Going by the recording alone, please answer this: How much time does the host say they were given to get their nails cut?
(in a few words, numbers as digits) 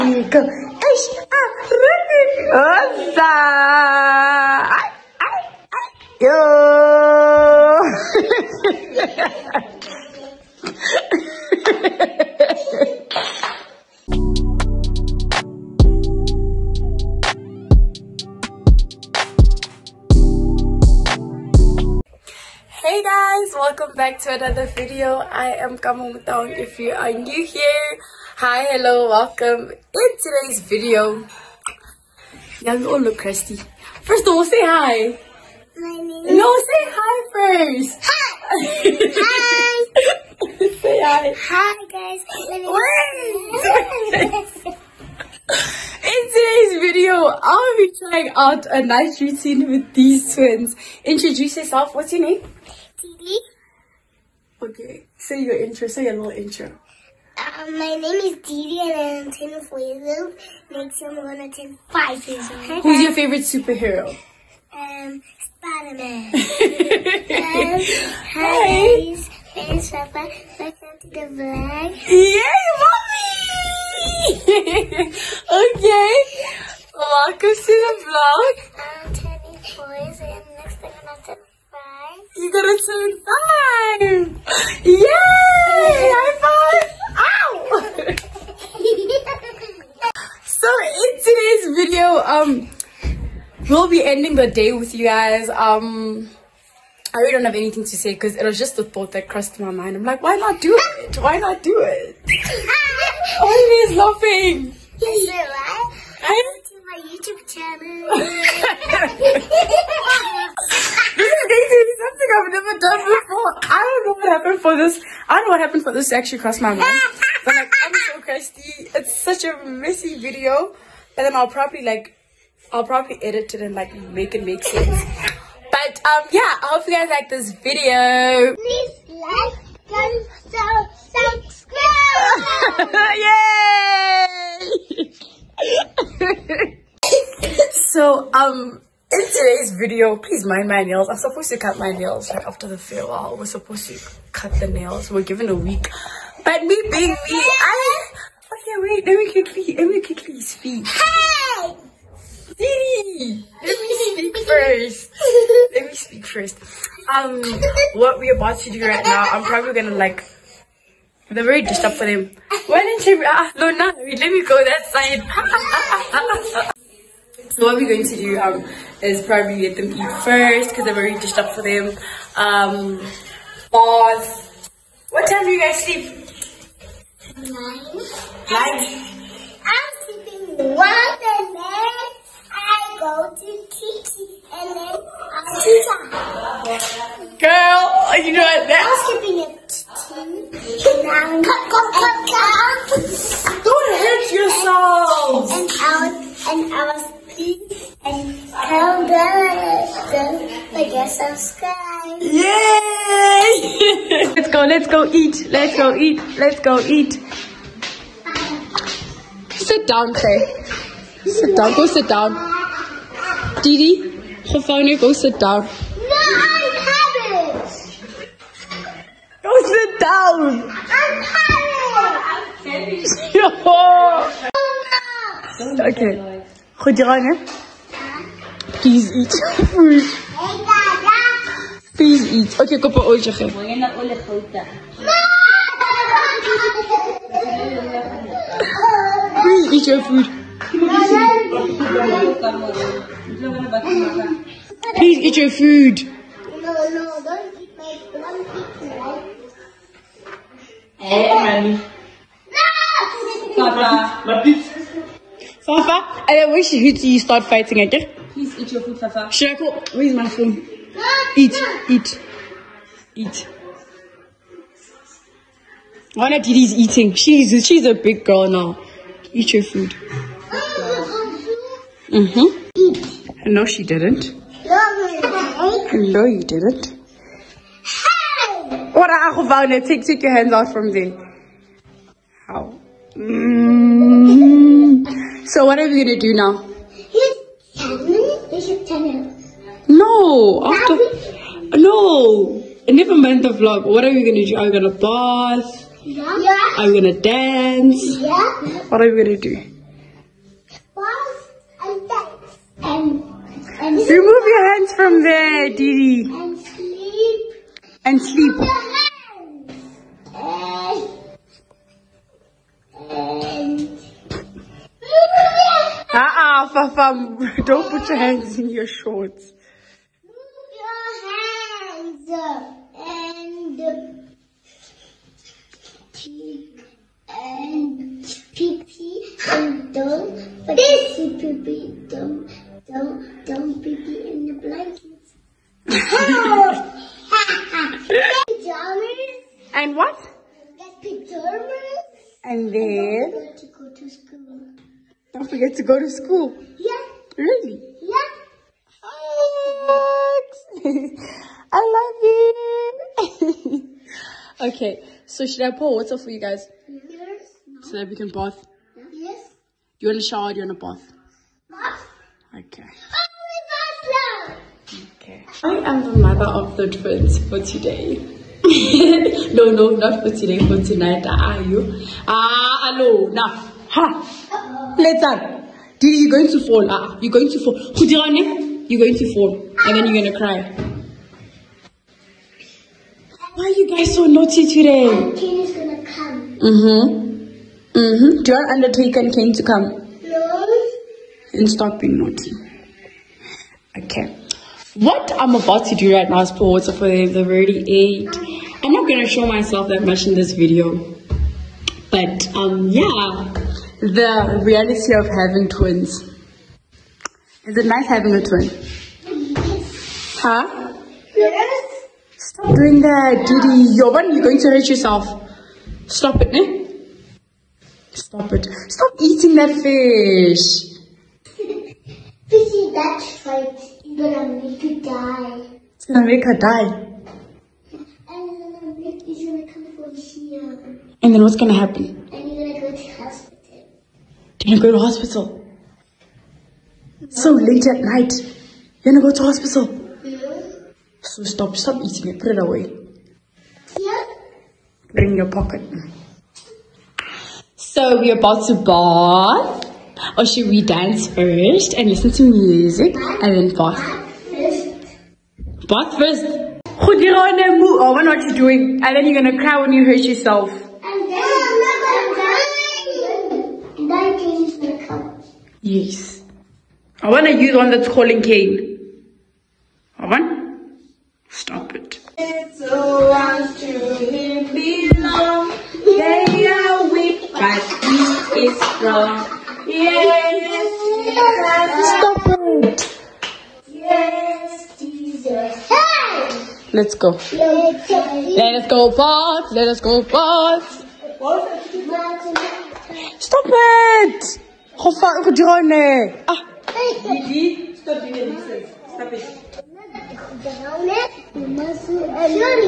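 a week.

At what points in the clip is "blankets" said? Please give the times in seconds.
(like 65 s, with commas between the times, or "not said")
334 s.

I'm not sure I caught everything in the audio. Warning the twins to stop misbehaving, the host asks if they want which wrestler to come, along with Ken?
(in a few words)
Undertaker.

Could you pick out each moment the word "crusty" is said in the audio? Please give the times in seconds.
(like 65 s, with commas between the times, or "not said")
33 s, 118 s.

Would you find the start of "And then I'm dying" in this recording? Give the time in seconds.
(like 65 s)
460 s.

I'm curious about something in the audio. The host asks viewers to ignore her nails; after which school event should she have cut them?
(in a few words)
the farewell.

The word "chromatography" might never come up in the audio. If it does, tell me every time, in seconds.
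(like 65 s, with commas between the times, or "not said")
not said.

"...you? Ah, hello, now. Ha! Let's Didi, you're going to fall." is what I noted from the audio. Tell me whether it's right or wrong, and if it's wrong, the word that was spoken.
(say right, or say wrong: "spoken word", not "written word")
right.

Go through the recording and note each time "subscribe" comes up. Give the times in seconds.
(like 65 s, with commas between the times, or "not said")
131 s, 201 s.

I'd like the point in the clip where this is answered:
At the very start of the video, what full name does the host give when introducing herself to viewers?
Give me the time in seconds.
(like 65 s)
25 s.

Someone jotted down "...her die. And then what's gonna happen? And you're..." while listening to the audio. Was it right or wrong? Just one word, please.
right.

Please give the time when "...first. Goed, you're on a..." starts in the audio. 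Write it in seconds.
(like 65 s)
456 s.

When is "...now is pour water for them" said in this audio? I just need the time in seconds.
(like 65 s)
396 s.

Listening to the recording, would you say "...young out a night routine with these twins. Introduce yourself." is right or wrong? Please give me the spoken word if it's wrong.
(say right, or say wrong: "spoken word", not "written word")
wrong: "trying", not "young".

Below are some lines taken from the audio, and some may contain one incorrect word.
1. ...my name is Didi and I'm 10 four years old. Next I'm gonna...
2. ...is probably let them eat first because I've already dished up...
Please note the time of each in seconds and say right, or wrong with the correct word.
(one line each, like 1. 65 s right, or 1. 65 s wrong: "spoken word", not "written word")
1. 57 s right
2. 169 s right.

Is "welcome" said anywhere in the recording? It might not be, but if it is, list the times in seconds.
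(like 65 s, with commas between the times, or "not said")
23 s, 29 s, 70 s, 76 s.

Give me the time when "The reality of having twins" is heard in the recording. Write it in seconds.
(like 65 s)
404 s.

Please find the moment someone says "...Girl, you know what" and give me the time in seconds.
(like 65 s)
187 s.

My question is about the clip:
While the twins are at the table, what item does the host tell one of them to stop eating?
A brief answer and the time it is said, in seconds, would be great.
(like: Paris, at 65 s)
fish, at 419 s.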